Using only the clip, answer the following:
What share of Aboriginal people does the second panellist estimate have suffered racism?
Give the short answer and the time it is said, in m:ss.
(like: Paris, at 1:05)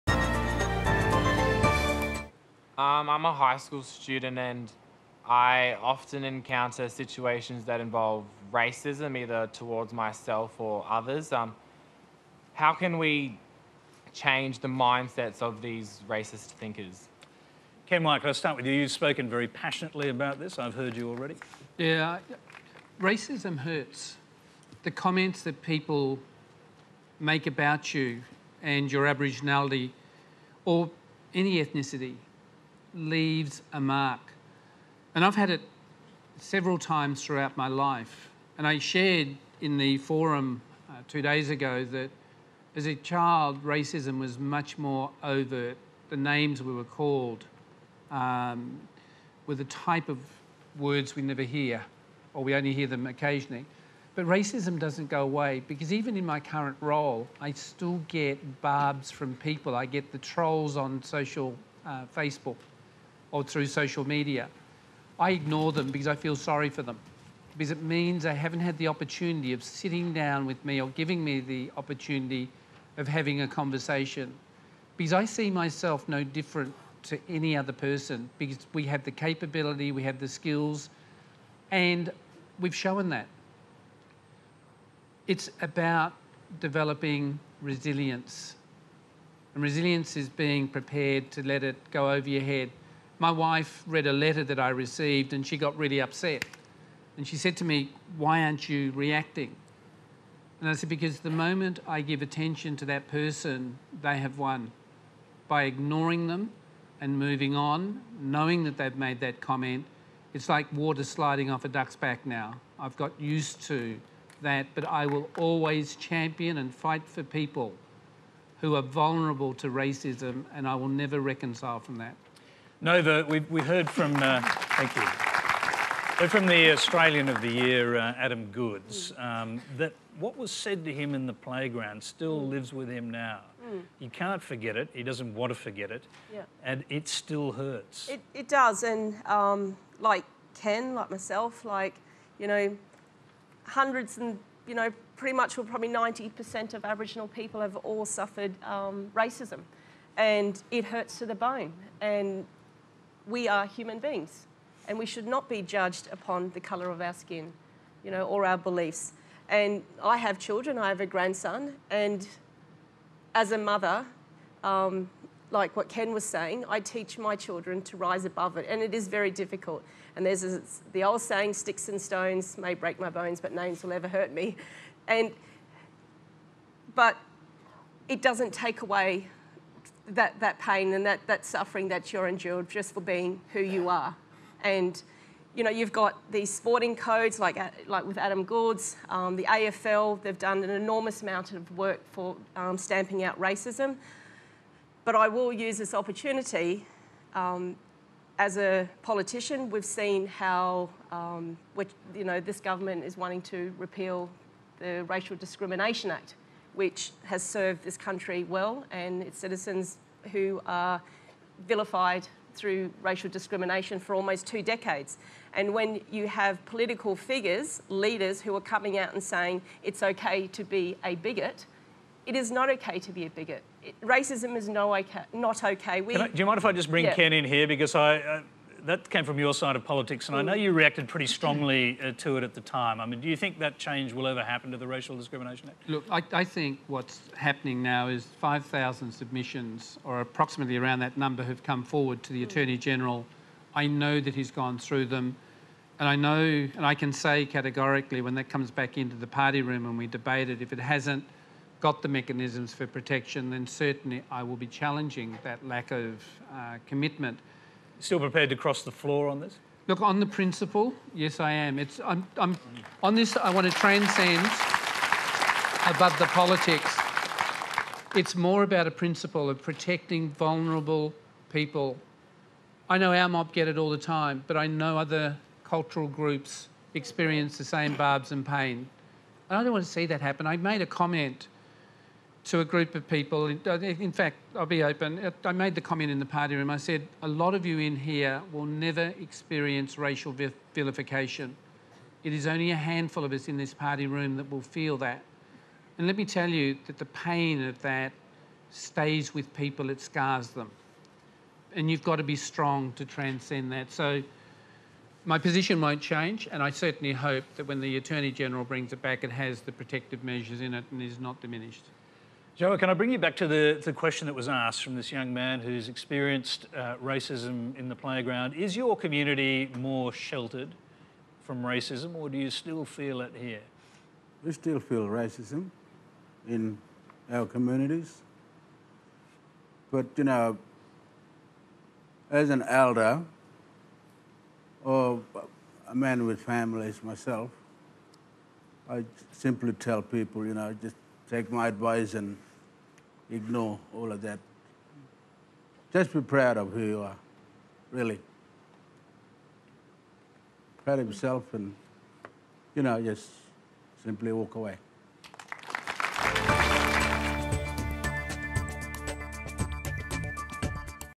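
90%, at 2:25.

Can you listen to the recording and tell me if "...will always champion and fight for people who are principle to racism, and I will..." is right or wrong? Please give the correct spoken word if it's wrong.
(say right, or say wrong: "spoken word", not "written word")
wrong: "vulnerable", not "principle".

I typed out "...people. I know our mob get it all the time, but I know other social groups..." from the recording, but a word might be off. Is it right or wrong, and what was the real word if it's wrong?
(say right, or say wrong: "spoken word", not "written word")
wrong: "cultural", not "social".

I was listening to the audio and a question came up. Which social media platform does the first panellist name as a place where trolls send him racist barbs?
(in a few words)
Facebook.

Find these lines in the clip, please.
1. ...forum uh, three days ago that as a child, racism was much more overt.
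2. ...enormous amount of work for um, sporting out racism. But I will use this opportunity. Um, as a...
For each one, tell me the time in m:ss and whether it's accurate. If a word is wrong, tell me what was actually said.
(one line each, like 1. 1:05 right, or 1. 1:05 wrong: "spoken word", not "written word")
1. 0:39 wrong: "two", not "three"
2. 3:10 wrong: "stamping", not "sporting".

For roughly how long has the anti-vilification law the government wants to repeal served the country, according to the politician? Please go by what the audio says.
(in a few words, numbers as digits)
almost two decades.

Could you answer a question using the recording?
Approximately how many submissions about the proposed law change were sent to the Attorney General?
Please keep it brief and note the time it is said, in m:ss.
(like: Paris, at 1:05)
5,000, at 3:58.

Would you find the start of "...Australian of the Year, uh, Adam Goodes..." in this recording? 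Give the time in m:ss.
2:06.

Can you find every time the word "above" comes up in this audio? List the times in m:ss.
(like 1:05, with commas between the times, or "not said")
2:48, 4:25.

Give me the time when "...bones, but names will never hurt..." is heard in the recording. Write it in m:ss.
2:53.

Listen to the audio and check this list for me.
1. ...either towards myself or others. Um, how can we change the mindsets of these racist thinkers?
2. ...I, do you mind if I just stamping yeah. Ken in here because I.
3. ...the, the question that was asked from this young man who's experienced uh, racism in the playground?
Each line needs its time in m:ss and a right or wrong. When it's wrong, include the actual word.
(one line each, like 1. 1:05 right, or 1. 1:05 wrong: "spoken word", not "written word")
1. 0:09 right
2. 3:46 wrong: "bring", not "stamping"
3. 5:13 right.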